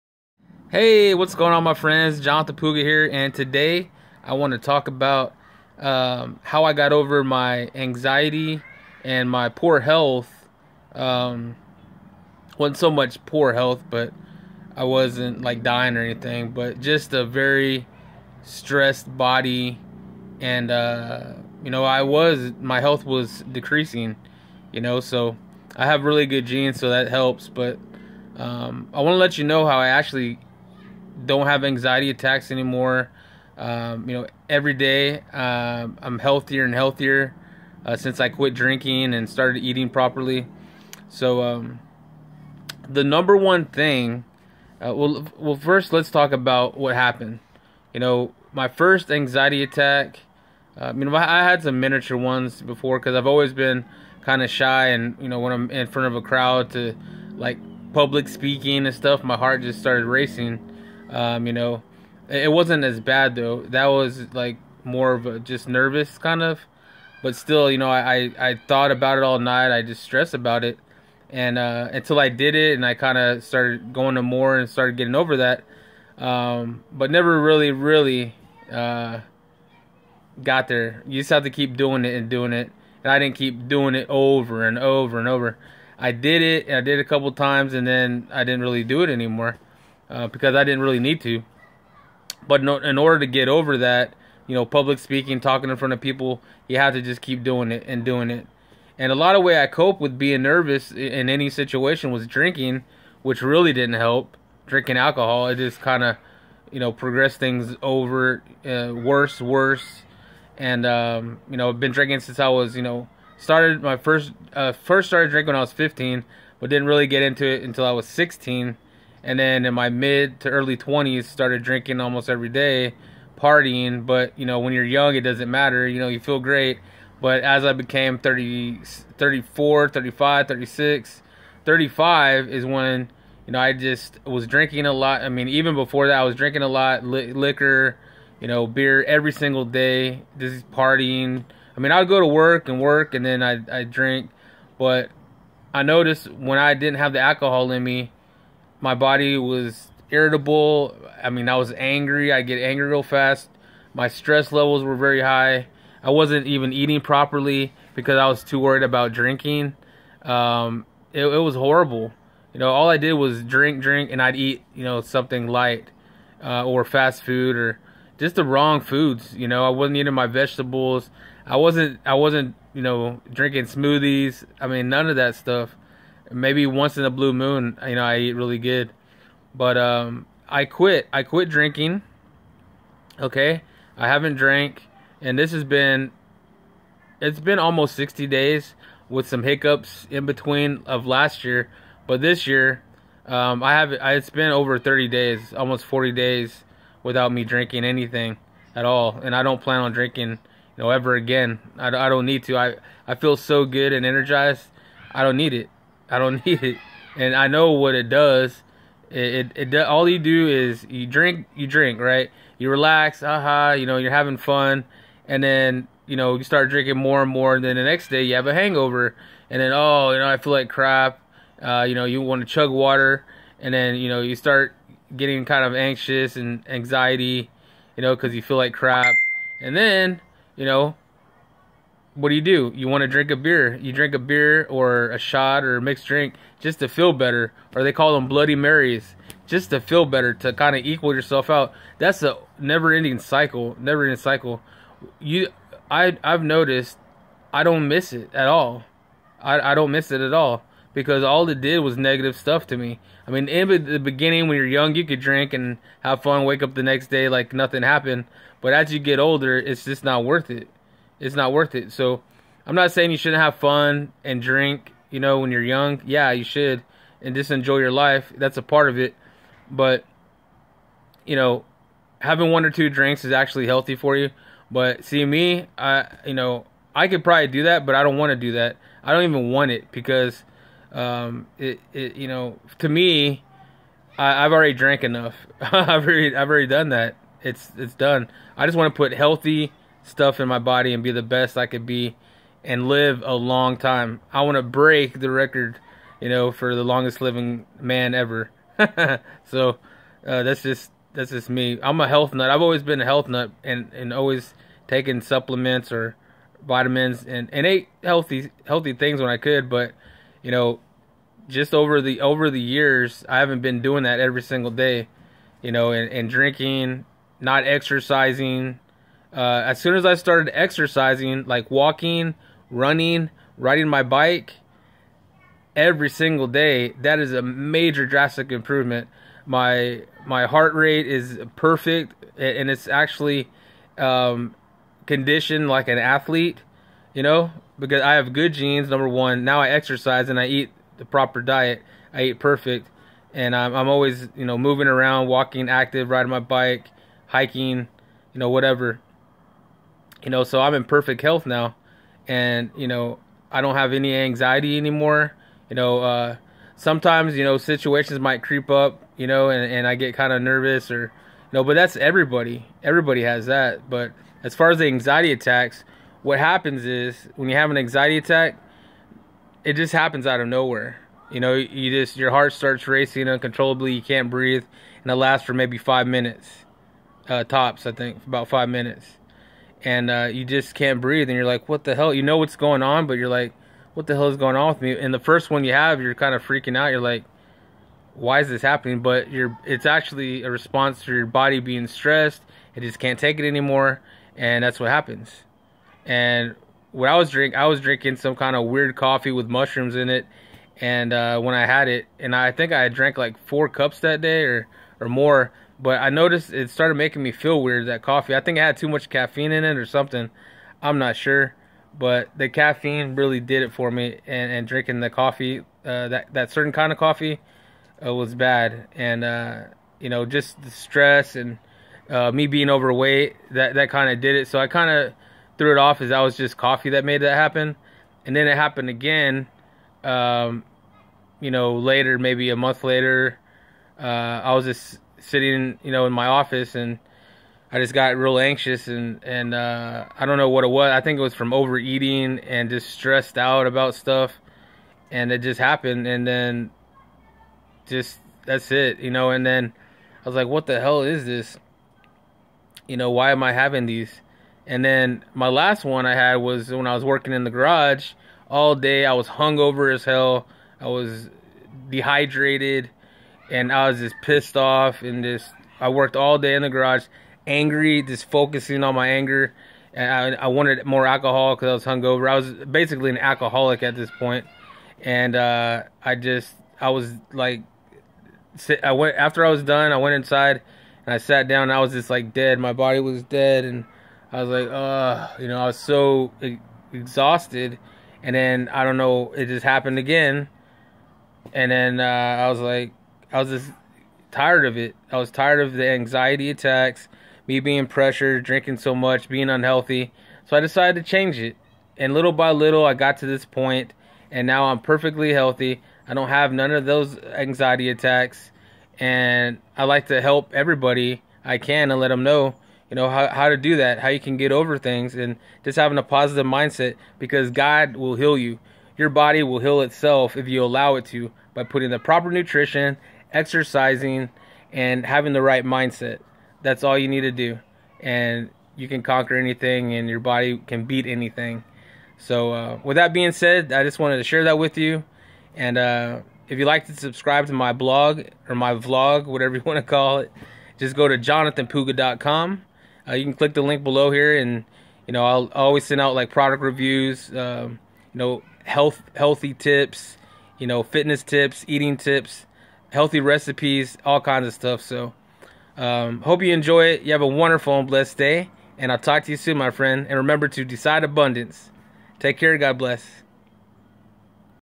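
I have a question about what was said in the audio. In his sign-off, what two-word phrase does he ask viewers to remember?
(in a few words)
decide abundance.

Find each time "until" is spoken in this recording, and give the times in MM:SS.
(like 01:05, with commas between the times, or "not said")
01:11, 01:57.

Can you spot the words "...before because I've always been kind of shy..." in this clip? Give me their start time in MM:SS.
00:52.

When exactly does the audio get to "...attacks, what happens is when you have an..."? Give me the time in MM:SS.
06:05.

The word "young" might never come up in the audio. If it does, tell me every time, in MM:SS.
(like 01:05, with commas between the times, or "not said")
02:04, 04:14, 04:25.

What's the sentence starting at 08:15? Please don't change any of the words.
I was tired of the anxiety attacks, me being pressured, drinking so much, being unhealthy.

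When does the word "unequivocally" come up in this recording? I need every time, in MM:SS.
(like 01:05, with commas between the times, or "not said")
not said.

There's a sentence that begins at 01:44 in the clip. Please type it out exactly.
Drinking alcohol, it just kind of, you know, progressed things over uh, worse, worse.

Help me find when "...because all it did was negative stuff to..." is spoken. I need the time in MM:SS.
04:10.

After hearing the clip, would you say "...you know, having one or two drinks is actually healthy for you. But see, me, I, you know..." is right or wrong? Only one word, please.
right.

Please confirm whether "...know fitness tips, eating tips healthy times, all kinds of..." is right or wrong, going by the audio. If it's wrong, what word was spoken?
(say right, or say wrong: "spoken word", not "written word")
wrong: "recipes", not "times".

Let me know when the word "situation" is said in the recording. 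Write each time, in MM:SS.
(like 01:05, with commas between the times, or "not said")
01:41, 05:57.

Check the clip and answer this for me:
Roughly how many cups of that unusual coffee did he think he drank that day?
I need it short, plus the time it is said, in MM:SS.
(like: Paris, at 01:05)
4, at 06:43.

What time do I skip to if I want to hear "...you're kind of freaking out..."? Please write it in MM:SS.
06:26.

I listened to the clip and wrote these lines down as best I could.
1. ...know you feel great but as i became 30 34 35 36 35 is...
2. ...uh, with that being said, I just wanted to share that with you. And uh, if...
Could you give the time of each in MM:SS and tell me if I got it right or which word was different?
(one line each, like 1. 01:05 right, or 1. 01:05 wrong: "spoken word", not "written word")
1. 02:05 right
2. 08:52 right.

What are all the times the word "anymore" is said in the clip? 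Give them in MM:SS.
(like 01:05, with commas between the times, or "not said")
00:32, 01:29, 05:54, 06:33.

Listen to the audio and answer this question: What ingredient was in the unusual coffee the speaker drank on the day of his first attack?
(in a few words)
mushrooms.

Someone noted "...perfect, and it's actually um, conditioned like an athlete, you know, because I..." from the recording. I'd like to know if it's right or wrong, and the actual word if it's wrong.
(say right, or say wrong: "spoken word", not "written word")
right.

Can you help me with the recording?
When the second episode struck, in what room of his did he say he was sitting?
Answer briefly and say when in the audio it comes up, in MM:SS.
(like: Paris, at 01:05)
office, at 07:16.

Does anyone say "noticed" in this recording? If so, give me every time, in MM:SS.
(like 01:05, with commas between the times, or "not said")
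02:25, 04:06, 06:46.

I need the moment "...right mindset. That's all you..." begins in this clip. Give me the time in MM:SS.
08:45.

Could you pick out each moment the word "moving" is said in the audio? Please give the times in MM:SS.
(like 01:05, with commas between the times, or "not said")
05:44.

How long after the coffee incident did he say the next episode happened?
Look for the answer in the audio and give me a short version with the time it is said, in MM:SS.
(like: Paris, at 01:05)
a month later, at 07:12.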